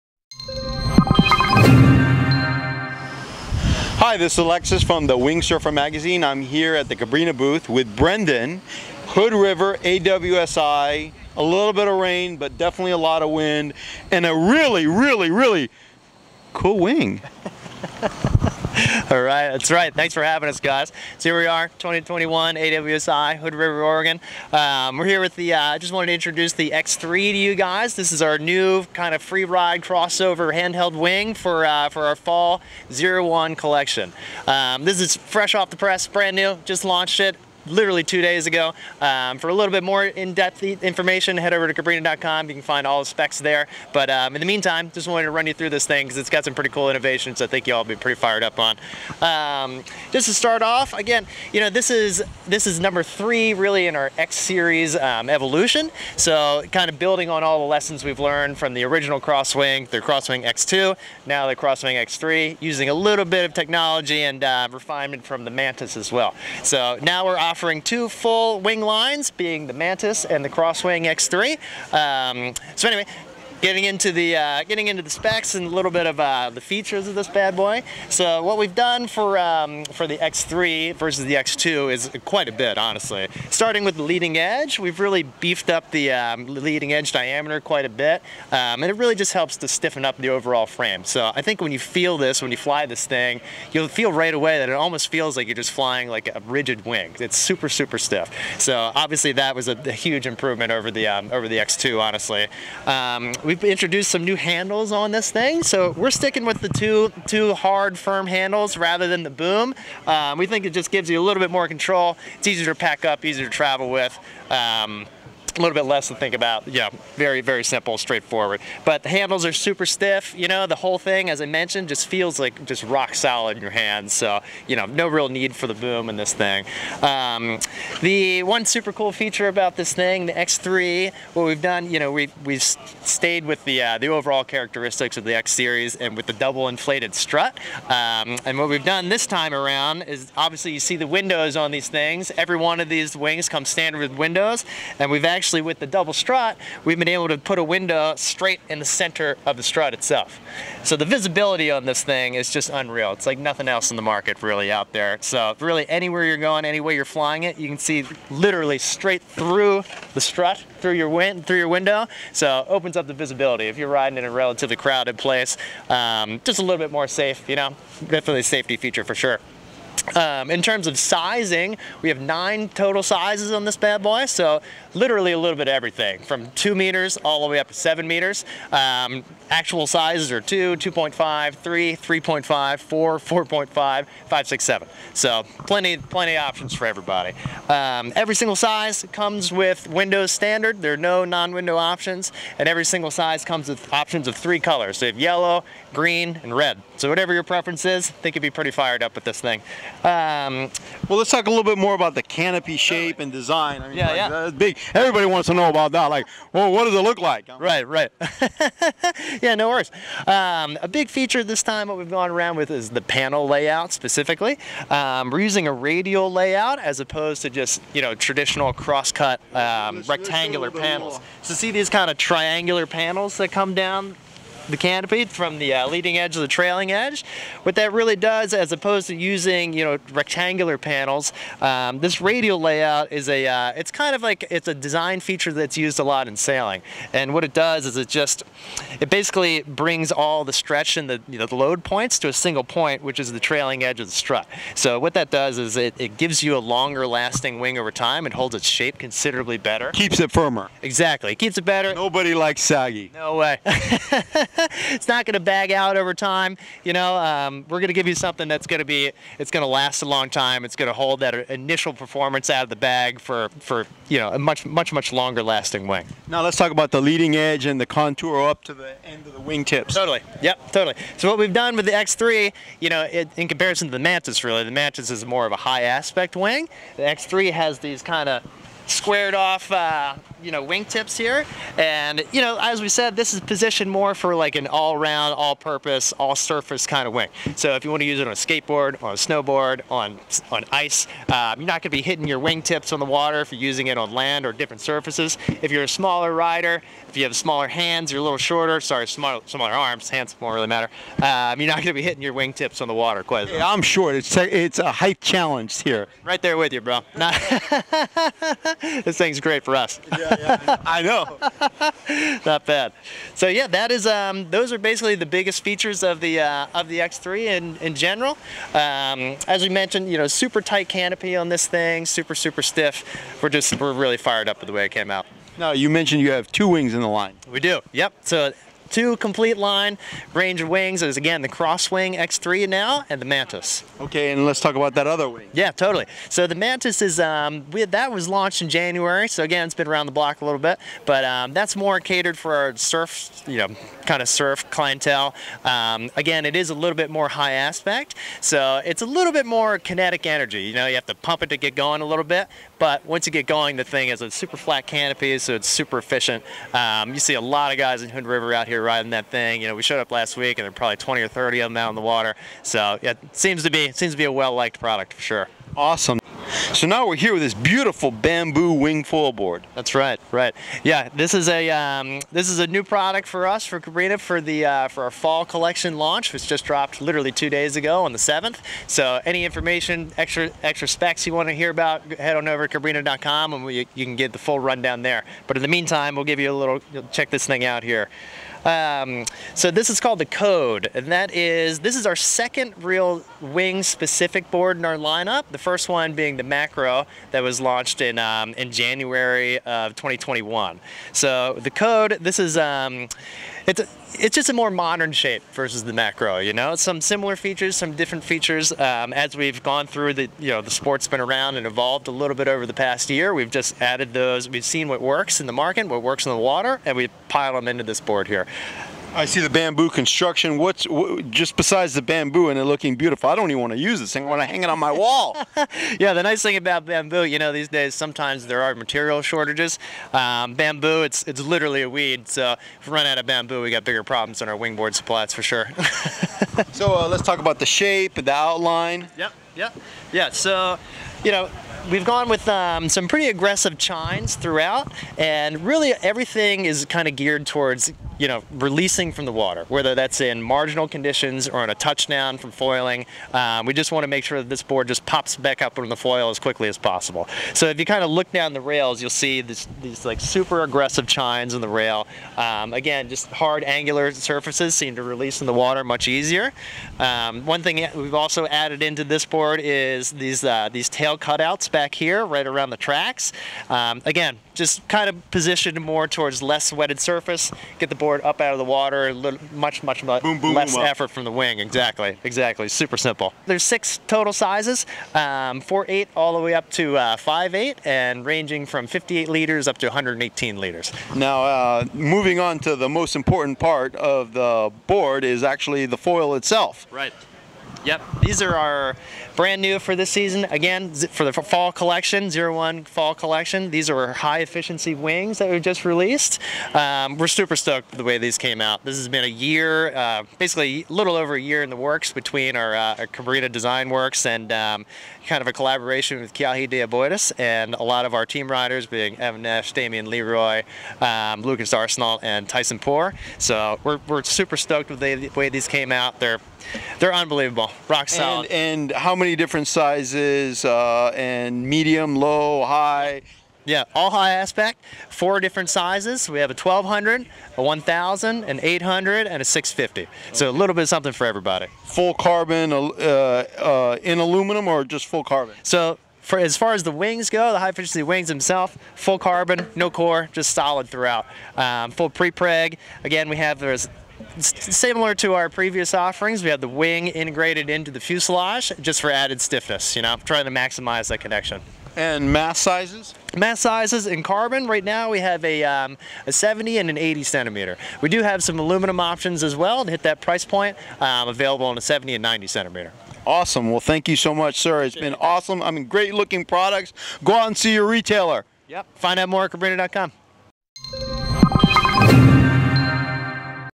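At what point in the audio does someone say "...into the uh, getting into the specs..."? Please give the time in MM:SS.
01:13.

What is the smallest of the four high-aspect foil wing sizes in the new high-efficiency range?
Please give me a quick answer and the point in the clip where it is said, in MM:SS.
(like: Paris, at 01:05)
650, at 08:59.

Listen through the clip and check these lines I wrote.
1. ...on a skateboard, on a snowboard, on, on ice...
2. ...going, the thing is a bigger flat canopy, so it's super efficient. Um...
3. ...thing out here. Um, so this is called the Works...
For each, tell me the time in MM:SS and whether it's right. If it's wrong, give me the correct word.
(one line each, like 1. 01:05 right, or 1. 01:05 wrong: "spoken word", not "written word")
1. 04:48 right
2. 05:53 wrong: "super", not "bigger"
3. 06:27 wrong: "Code", not "Works".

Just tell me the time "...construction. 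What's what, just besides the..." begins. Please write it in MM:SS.
06:59.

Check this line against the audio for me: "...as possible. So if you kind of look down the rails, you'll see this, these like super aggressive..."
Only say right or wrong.
right.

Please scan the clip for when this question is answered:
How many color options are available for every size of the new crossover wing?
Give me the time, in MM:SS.
03:14.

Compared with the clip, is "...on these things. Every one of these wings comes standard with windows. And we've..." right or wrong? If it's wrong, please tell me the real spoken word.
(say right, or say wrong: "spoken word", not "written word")
right.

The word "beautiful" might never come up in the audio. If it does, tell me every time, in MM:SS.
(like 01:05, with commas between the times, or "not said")
06:07, 07:02.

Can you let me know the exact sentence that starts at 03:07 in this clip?
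Um, every single size comes with Windows Standard.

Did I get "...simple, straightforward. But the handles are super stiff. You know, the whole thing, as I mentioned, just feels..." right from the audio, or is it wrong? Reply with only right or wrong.
right.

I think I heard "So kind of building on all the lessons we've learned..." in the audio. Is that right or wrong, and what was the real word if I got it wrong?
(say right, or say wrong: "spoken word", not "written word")
right.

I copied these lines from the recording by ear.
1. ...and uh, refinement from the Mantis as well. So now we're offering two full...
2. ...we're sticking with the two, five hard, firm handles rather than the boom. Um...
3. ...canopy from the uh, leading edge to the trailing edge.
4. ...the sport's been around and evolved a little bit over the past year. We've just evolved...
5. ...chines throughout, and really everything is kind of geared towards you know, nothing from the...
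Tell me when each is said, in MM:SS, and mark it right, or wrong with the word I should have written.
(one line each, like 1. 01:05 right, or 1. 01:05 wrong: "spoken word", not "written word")
1. 01:04 right
2. 01:45 wrong: "two", not "five"
3. 03:44 right
4. 06:50 wrong: "added", not "evolved"
5. 07:23 wrong: "releasing", not "nothing".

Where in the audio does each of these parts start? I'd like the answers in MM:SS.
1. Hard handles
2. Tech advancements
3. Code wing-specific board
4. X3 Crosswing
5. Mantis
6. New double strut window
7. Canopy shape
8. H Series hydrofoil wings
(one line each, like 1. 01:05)
1. 01:42
2. 01:25
3. 06:05
4. 00:24
5. 05:26
6. 02:20
7. 03:20
8. 08:17.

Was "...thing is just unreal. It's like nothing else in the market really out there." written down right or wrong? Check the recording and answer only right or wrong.
right.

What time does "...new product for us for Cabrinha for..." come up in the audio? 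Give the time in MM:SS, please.
06:12.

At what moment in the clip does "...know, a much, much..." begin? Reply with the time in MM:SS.
04:24.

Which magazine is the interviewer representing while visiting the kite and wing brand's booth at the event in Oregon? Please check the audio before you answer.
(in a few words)
Wing Surfer Magazine.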